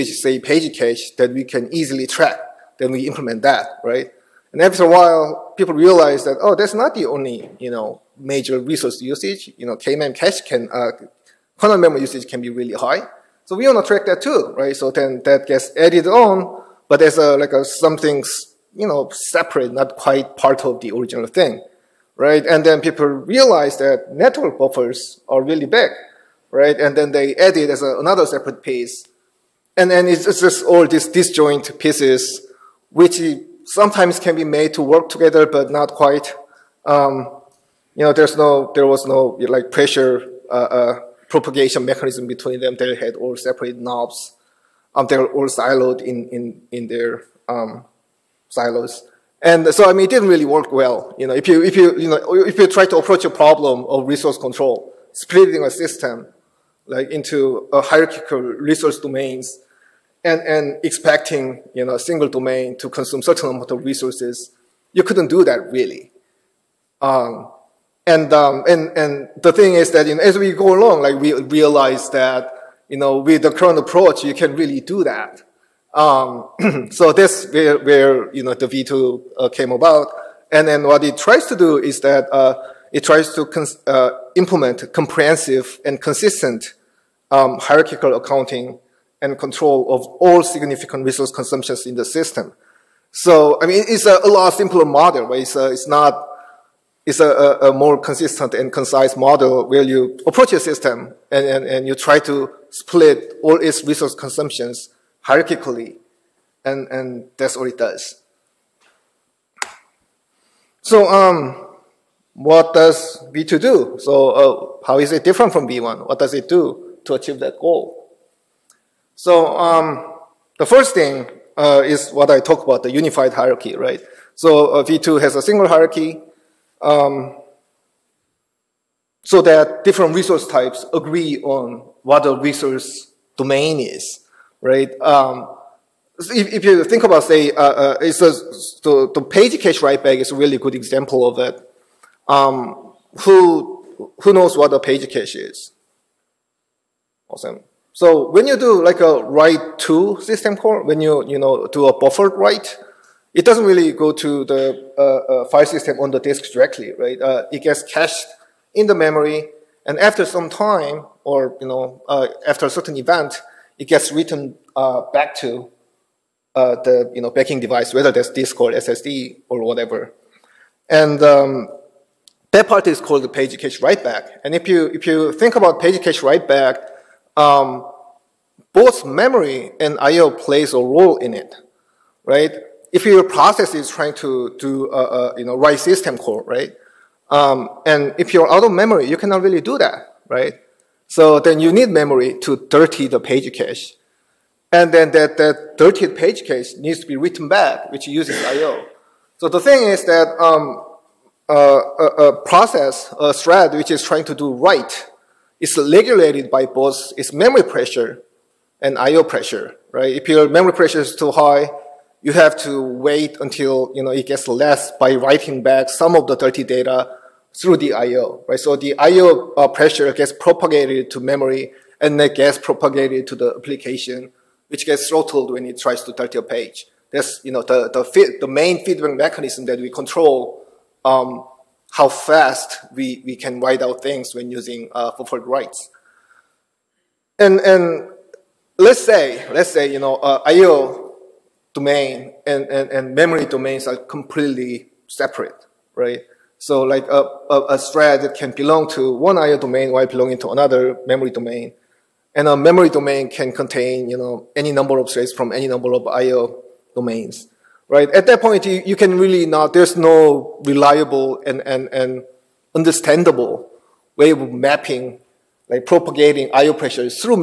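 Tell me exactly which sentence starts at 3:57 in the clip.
And and let's say let's say you know uh, I/O domain and, and and memory domains are completely separate, right?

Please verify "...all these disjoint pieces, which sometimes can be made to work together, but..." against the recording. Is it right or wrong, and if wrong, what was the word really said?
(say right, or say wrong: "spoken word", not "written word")
right.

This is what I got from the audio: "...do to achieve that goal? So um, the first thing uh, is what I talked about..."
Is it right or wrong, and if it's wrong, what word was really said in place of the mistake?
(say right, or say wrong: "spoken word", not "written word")
right.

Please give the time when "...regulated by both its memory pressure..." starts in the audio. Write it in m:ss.
3:25.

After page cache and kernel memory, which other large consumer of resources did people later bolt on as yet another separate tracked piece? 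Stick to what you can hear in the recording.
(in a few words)
Network buffers.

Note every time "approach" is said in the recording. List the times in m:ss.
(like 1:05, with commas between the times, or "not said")
0:52, 1:13, 1:40.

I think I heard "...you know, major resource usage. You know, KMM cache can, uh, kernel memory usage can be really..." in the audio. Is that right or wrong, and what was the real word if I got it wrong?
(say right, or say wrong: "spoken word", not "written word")
right.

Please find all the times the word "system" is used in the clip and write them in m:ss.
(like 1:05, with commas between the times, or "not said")
0:55, 1:32, 1:40, 2:30, 2:35, 3:05.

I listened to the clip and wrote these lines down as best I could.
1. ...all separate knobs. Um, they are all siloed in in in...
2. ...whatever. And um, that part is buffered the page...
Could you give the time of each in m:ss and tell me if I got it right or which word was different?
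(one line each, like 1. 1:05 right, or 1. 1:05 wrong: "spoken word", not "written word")
1. 0:43 right
2. 2:49 wrong: "called", not "buffered".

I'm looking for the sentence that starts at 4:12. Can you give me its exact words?
And a memory domain can contain, you know, any number of threads from any number of IO domains, right?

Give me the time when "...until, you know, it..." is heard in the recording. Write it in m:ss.
3:33.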